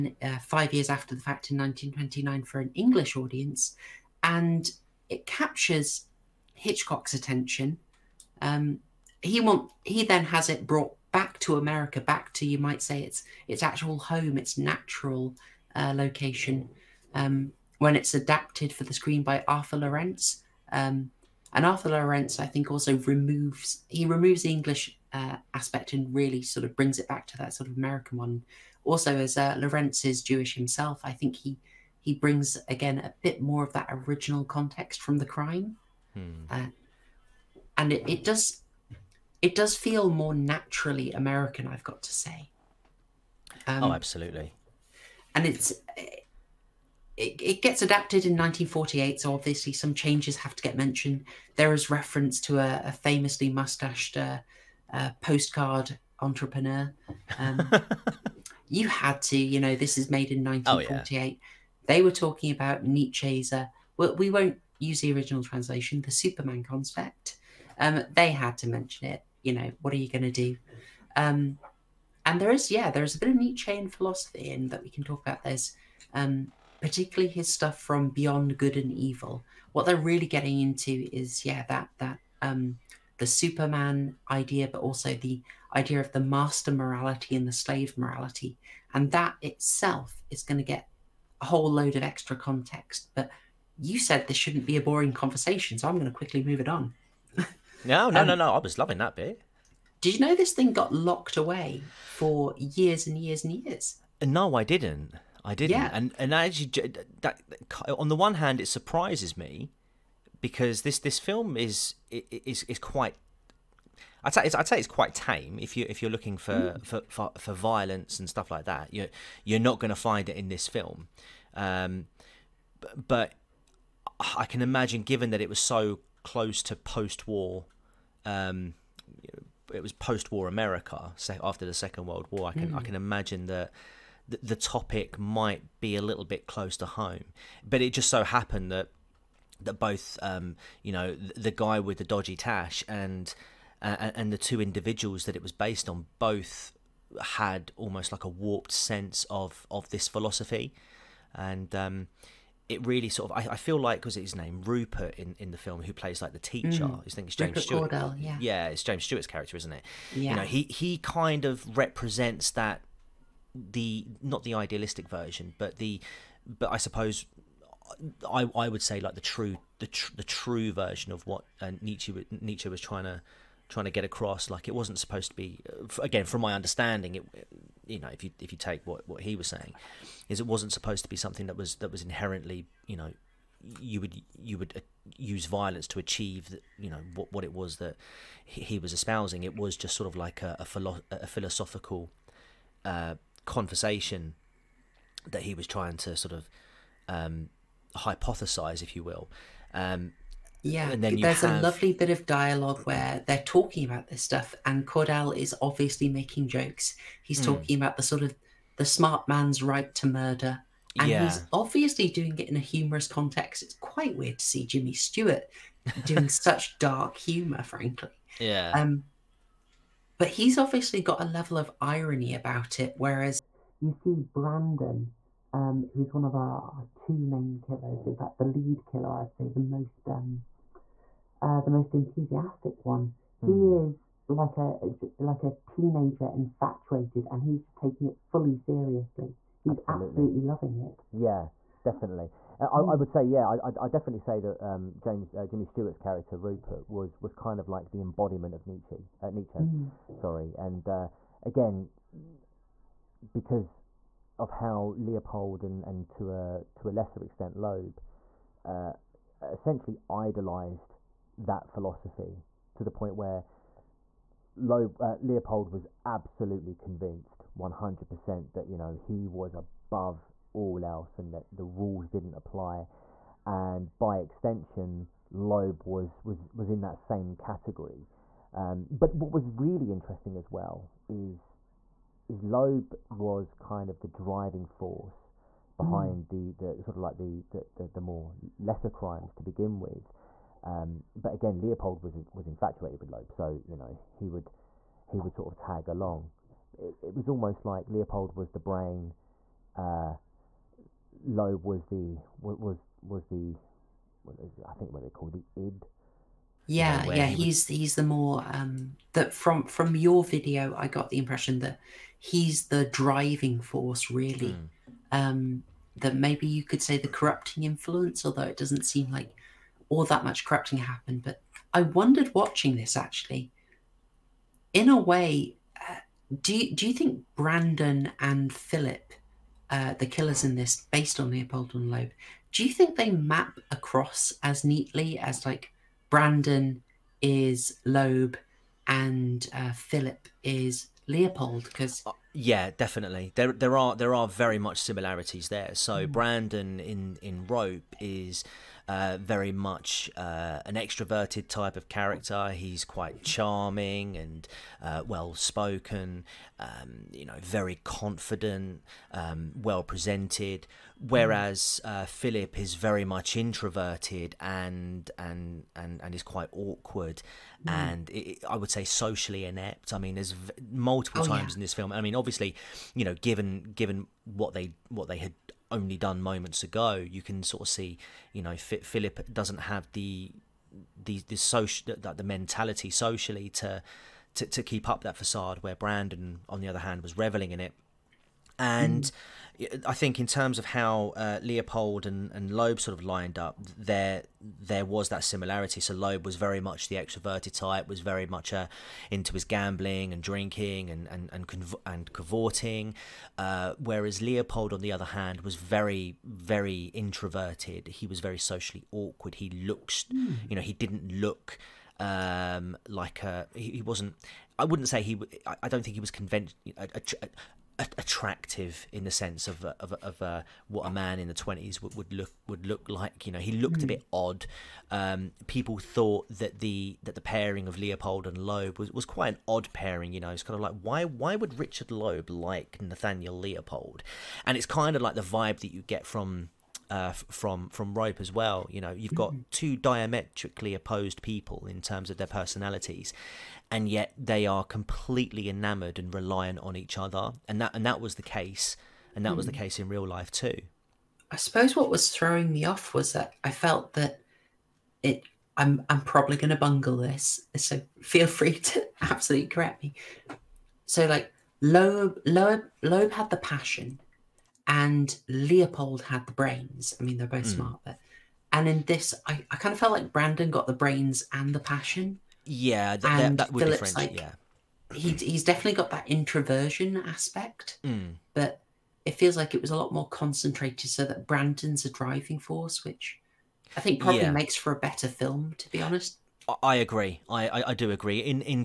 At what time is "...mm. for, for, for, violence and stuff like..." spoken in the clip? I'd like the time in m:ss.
1:56.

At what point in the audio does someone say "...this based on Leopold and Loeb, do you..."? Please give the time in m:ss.
5:30.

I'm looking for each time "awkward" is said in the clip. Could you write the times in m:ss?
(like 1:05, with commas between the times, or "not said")
6:06, 6:48.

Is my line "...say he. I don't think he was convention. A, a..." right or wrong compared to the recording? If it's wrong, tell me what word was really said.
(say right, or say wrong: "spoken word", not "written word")
right.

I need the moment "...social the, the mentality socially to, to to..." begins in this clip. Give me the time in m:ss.
6:21.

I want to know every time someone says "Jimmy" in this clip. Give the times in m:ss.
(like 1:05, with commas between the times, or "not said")
3:34, 4:05.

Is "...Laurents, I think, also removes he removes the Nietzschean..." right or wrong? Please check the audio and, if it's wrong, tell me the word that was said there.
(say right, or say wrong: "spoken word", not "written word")
wrong: "English", not "Nietzschean".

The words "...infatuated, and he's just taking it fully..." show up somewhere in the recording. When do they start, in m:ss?
3:56.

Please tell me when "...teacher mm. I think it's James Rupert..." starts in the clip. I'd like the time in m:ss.
2:36.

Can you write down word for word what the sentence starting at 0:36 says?
uh, and it, it does it does feel more naturally American.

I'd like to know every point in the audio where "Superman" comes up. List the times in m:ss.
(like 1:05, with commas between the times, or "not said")
1:06, 1:23.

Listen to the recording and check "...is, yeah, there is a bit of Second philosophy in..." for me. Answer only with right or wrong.
wrong.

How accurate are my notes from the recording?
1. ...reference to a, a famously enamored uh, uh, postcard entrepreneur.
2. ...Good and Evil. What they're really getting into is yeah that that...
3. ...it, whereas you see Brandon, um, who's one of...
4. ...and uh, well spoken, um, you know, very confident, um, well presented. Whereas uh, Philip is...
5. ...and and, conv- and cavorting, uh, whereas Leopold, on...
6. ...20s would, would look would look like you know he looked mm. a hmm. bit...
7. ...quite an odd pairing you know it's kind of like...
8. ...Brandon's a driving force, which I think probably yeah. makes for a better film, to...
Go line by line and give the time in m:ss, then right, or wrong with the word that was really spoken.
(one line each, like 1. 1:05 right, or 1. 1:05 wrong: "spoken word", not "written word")
1. 0:51 wrong: "mustached", not "enamored"
2. 1:18 right
3. 3:42 right
4. 5:54 right
5. 6:41 right
6. 7:01 right
7. 7:09 right
8. 8:01 right.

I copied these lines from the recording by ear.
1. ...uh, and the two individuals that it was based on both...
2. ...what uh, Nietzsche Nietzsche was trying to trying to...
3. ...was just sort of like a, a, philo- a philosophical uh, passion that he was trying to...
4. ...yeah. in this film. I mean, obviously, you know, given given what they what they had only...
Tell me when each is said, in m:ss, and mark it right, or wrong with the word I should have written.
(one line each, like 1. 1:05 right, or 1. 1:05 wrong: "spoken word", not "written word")
1. 2:23 right
2. 2:51 right
3. 3:09 wrong: "conversation", not "passion"
4. 6:11 right.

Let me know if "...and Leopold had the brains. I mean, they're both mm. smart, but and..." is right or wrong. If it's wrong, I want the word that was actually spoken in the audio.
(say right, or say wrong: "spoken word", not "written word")
right.